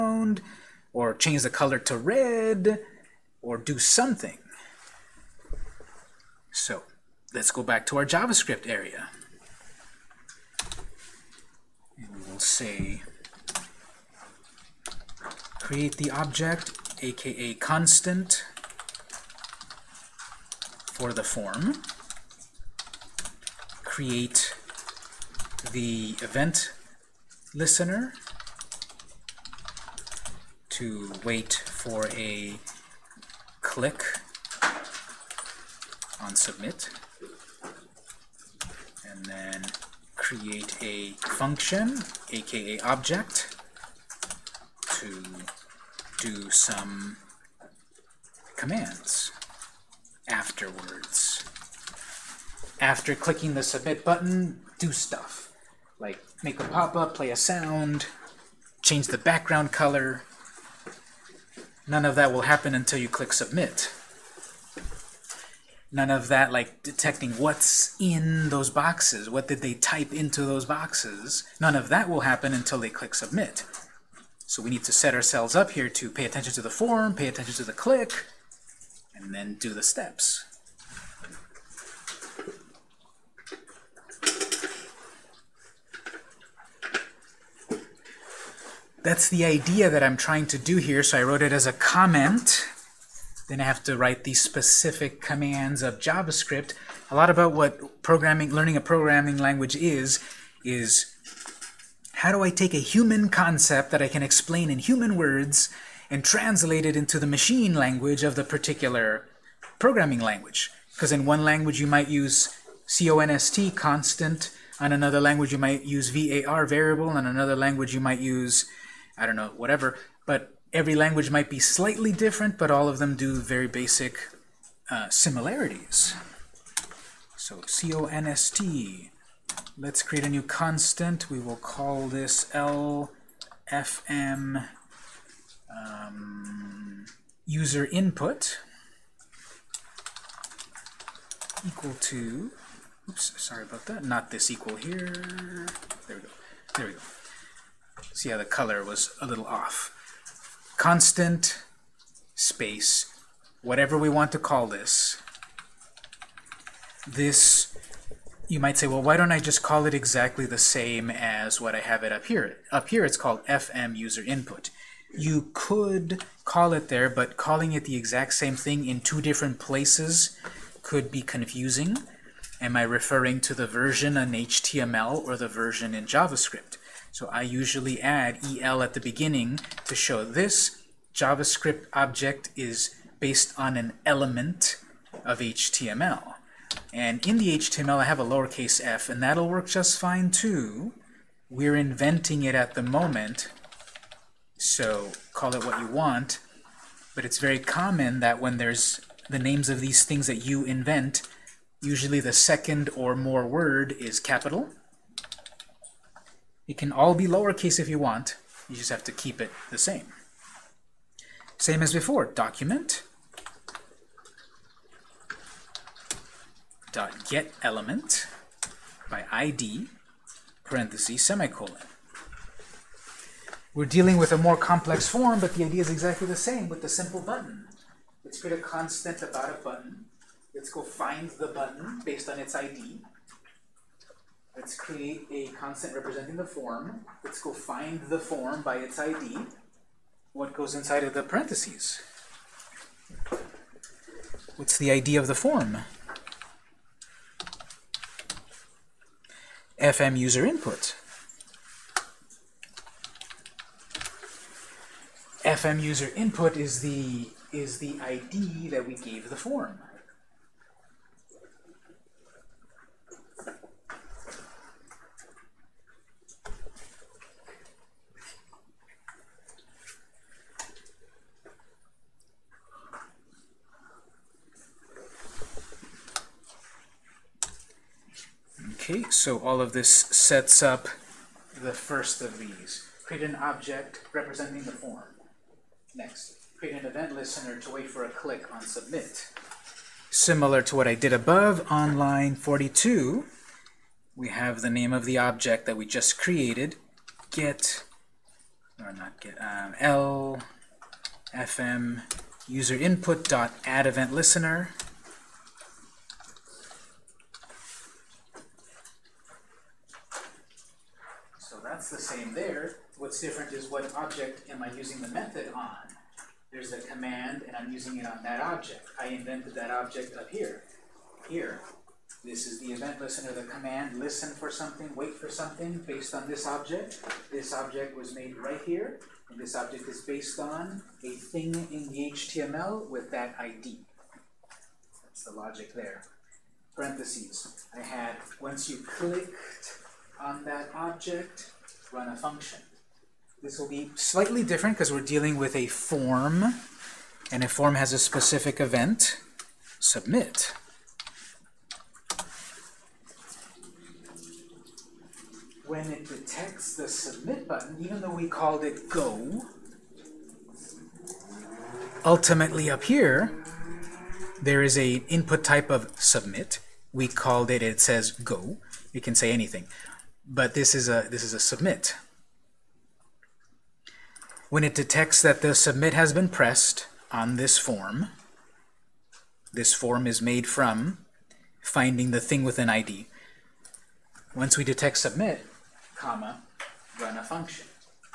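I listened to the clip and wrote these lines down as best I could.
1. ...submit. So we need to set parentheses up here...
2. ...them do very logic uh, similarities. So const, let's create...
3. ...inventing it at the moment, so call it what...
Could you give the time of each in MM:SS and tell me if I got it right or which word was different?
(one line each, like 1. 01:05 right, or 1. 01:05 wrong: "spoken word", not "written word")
1. 01:13 wrong: "ourselves", not "parentheses"
2. 02:02 wrong: "basic", not "logic"
3. 03:11 right.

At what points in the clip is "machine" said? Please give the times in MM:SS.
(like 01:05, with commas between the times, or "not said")
01:47.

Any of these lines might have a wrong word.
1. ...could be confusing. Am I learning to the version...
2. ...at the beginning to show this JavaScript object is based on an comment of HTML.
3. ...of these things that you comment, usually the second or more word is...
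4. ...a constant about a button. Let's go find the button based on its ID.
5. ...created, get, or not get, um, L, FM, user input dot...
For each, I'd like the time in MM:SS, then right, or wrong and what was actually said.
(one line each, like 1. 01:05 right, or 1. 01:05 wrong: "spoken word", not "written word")
1. 02:50 wrong: "referring", not "learning"
2. 02:58 wrong: "element", not "comment"
3. 03:19 wrong: "invent", not "comment"
4. 03:48 right
5. 04:56 right.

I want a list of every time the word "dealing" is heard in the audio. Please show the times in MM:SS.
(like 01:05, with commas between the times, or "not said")
03:43, 05:44.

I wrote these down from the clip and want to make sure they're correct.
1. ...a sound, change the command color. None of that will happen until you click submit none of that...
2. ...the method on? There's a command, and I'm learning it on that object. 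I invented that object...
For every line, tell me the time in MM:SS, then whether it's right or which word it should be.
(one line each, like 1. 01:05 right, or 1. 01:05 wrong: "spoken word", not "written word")
1. 00:57 wrong: "background", not "command"
2. 05:14 wrong: "using", not "learning".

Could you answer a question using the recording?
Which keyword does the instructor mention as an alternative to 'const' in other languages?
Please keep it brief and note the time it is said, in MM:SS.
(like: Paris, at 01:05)
var, at 01:56.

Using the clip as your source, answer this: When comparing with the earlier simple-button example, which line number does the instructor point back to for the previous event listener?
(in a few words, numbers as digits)
42.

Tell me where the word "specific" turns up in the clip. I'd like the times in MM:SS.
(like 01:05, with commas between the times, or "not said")
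01:34, 05:47.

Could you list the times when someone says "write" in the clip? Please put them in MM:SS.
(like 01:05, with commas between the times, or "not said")
01:33.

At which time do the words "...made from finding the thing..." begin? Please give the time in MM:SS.
06:20.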